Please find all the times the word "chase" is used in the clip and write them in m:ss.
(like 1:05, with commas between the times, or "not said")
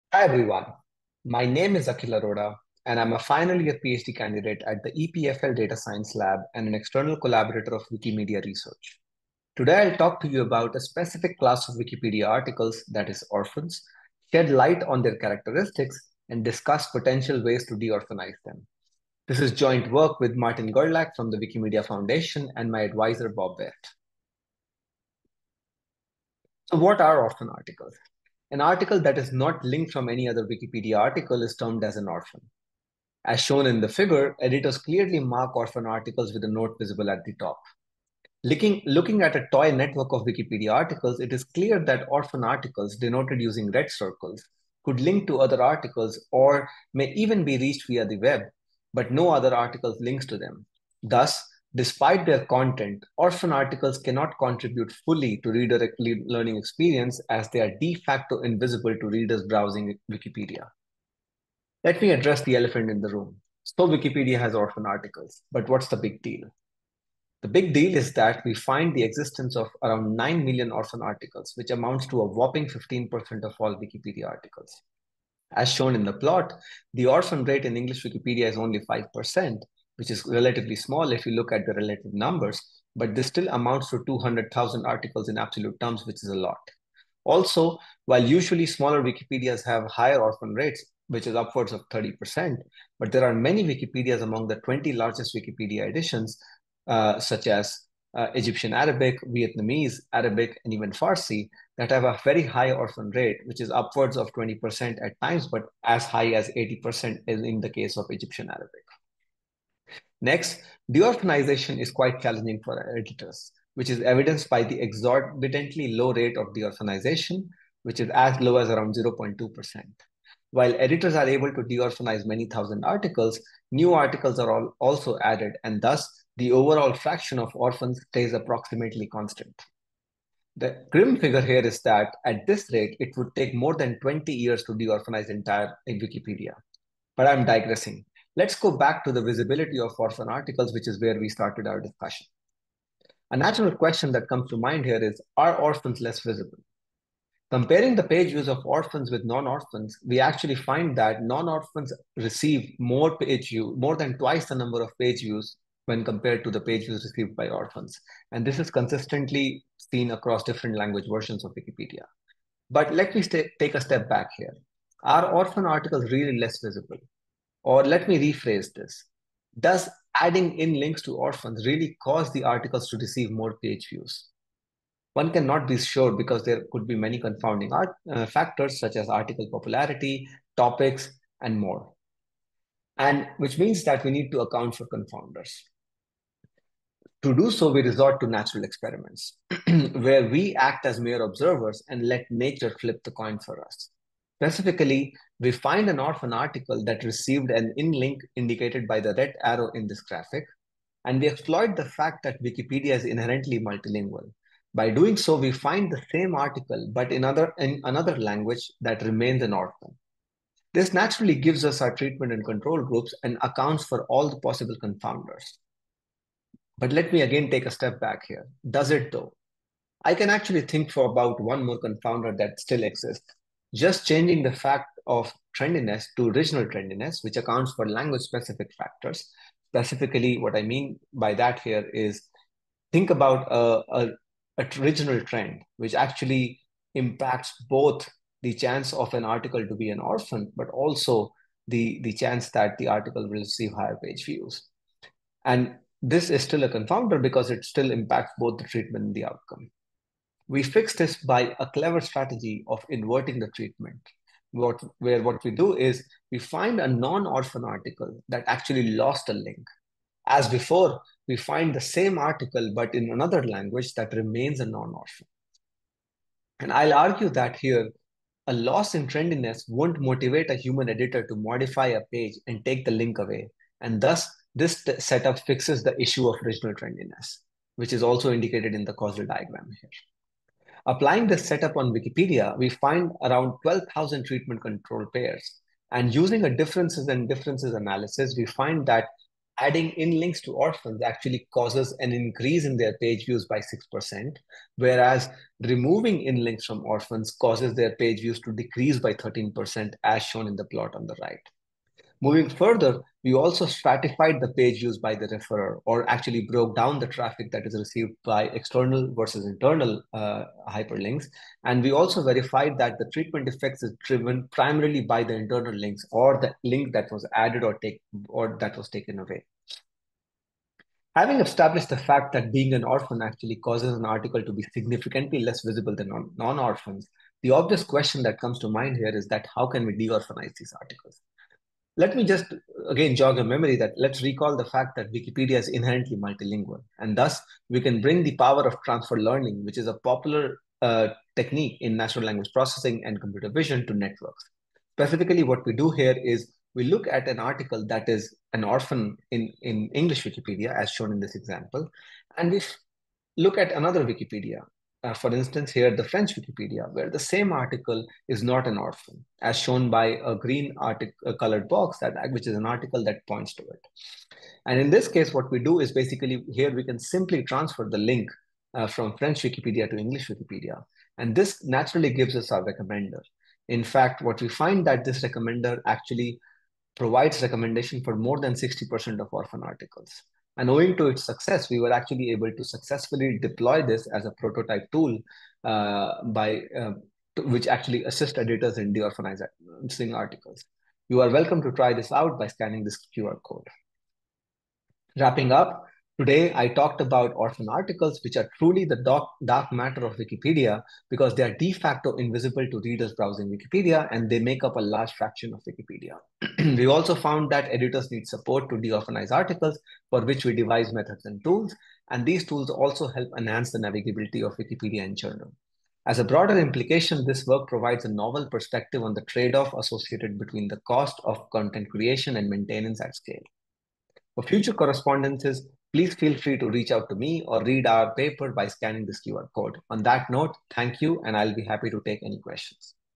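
not said.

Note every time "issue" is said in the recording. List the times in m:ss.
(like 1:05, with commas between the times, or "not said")
4:35.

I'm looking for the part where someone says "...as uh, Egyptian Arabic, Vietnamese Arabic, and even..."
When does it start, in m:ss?
1:37.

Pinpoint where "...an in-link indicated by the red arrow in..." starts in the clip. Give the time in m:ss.
3:17.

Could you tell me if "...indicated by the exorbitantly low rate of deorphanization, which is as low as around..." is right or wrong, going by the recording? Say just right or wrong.
wrong.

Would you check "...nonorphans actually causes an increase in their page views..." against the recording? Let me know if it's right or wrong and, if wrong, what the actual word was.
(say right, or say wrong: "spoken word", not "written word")
wrong: "orphans", not "nonorphans".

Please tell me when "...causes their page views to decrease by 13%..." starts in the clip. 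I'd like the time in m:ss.
4:57.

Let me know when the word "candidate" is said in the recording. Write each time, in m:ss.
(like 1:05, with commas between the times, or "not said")
0:04.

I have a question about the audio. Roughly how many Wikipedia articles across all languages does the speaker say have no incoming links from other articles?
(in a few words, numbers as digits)
9 million.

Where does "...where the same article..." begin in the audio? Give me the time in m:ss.
5:56.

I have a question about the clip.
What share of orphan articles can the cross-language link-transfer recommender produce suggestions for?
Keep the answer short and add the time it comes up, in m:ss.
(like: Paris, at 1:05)
more than 60%, at 6:18.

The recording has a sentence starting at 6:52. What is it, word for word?
And these tools also help enhance the navigability of Wikipedia in general.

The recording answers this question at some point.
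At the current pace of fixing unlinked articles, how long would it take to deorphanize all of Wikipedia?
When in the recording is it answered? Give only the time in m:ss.
2:13.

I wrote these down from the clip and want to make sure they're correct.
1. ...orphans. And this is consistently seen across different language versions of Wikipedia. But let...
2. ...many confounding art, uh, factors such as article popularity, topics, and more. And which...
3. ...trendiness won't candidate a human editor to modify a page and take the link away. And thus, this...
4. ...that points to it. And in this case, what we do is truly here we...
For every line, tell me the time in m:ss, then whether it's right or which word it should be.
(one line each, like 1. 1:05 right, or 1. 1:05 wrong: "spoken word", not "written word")
1. 2:37 right
2. 2:56 right
3. 4:29 wrong: "motivate", not "candidate"
4. 6:03 wrong: "basically", not "truly".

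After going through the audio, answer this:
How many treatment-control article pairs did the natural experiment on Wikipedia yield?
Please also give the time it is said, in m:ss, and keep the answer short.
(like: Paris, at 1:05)
12,000, at 4:43.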